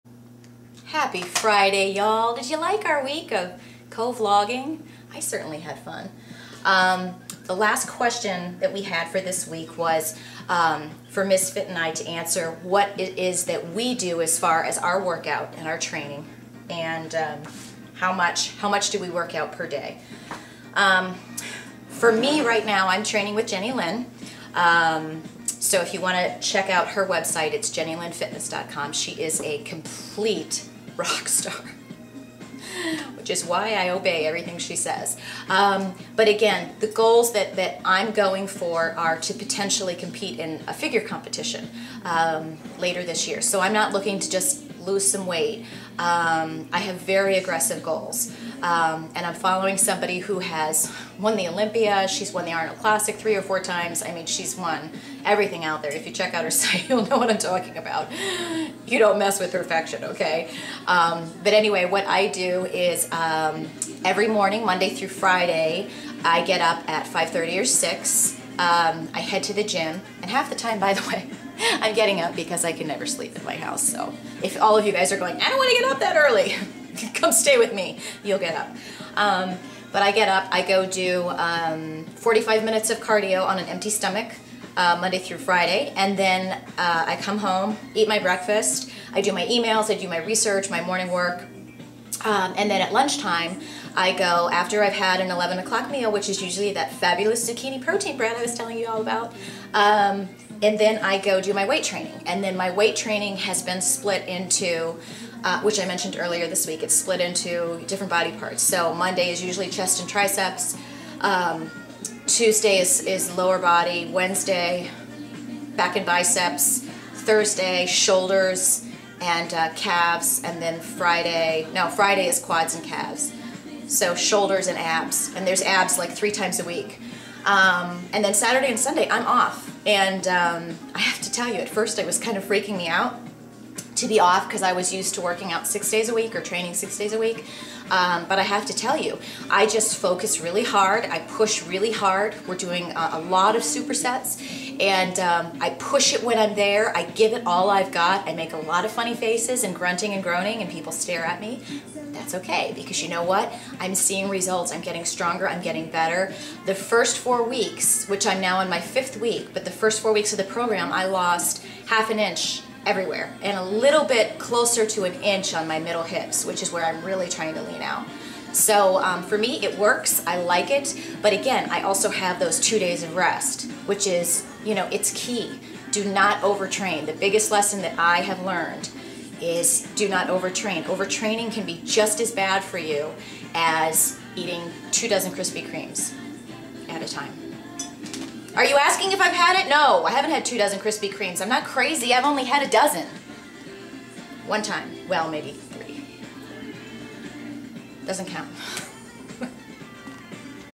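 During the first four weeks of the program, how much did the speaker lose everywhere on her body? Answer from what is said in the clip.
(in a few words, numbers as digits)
half an inch.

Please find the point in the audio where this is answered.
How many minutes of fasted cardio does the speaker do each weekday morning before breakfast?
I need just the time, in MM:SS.
01:22.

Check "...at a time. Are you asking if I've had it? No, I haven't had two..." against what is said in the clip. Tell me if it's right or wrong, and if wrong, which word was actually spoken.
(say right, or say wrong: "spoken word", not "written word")
right.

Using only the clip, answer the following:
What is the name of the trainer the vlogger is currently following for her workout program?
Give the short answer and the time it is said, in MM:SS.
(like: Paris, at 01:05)
Jenny Lynn, at 00:23.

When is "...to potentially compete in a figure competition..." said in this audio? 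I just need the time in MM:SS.
00:39.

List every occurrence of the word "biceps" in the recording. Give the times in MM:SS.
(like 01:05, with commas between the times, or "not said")
01:56.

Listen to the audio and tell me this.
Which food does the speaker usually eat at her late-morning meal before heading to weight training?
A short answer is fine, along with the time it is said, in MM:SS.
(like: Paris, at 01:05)
zucchini protein bread, at 01:37.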